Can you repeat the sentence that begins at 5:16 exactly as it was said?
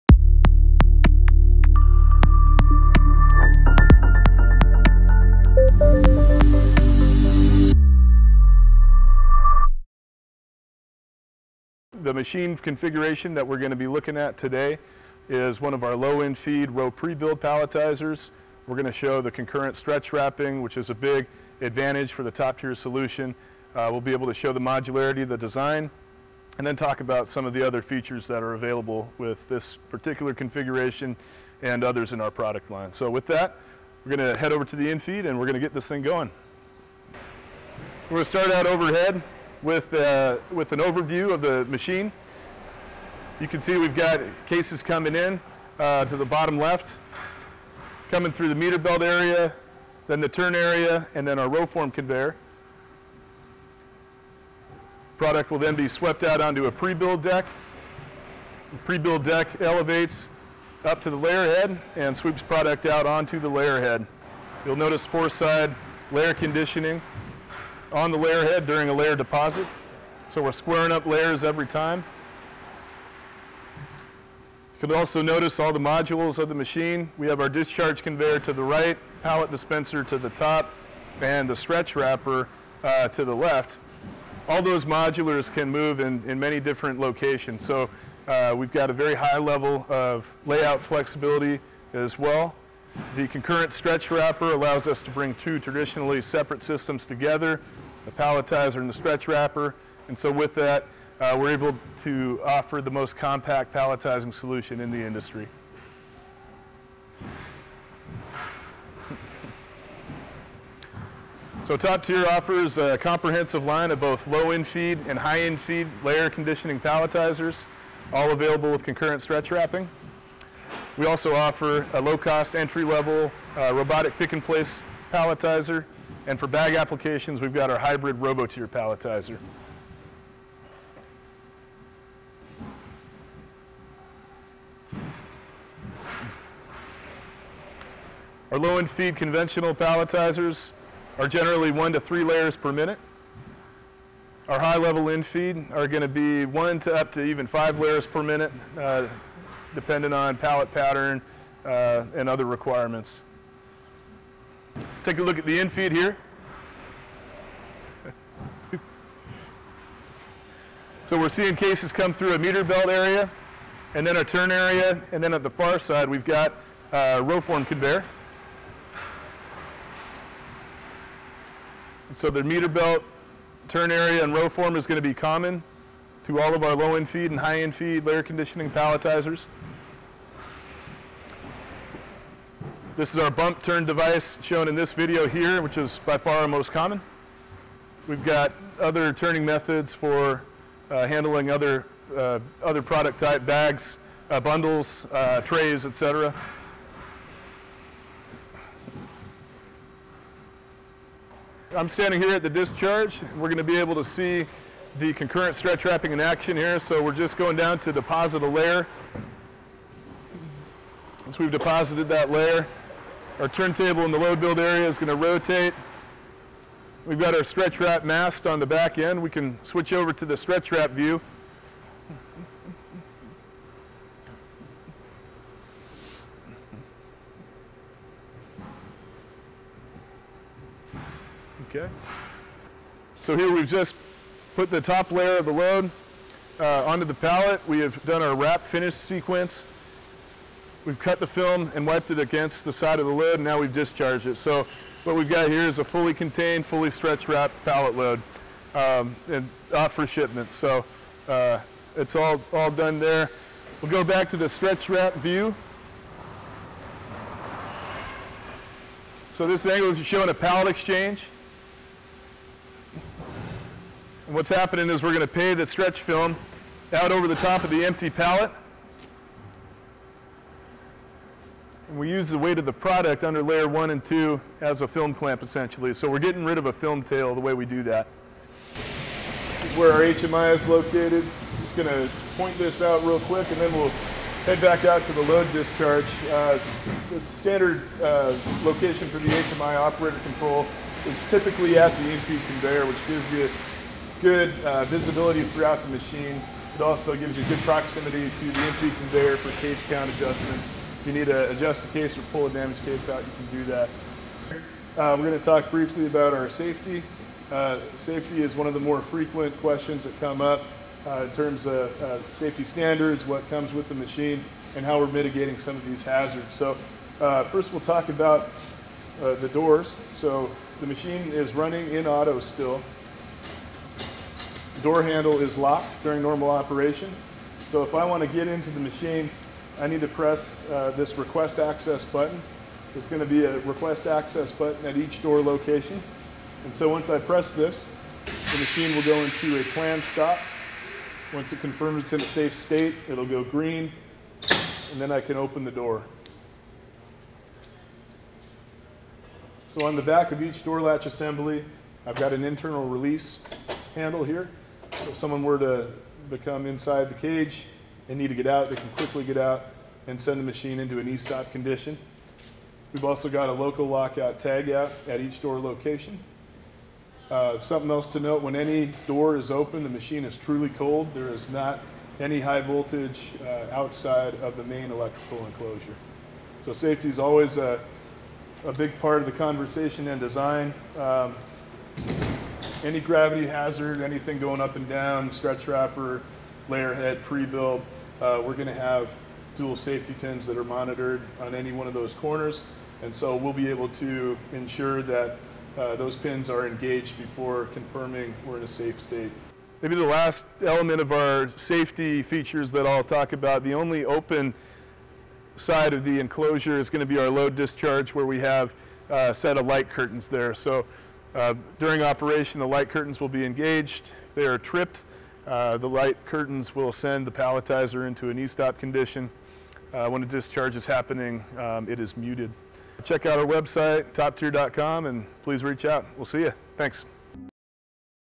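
So uh, first we'll talk about uh, the doors.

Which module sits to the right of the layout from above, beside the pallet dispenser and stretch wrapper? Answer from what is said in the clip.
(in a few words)
Discharge conveyor.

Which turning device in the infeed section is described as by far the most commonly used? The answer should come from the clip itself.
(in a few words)
Bump turn device.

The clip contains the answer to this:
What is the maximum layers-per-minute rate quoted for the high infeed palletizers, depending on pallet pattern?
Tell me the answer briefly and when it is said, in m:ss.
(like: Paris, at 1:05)
5, at 2:27.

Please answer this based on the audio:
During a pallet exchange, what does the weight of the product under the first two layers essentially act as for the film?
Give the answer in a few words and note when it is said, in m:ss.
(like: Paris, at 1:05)
Film clamp, at 4:34.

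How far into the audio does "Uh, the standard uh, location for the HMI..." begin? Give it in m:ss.
4:46.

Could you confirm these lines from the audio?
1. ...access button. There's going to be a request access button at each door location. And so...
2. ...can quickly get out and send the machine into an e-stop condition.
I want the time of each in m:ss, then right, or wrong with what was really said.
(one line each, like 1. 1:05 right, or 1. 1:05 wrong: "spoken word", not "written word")
1. 5:31 right
2. 5:58 right.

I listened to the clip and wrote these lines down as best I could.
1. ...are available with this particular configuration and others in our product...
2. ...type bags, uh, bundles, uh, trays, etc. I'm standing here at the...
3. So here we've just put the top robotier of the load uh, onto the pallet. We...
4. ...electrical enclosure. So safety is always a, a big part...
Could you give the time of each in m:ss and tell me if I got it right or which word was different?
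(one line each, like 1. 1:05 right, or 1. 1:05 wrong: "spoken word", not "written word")
1. 0:28 right
2. 3:13 right
3. 3:53 wrong: "layer", not "robotier"
4. 6:14 right.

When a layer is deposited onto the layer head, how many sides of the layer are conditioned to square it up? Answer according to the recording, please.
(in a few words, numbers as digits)
4.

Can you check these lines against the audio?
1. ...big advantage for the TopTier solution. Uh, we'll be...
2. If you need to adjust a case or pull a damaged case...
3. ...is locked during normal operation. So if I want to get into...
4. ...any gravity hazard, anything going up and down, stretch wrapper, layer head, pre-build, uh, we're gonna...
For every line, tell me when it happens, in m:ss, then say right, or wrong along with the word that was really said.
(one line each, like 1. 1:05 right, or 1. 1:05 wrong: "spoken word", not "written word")
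1. 0:20 right
2. 5:01 right
3. 5:25 right
4. 6:22 right.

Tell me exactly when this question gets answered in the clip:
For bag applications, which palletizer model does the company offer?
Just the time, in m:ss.
2:07.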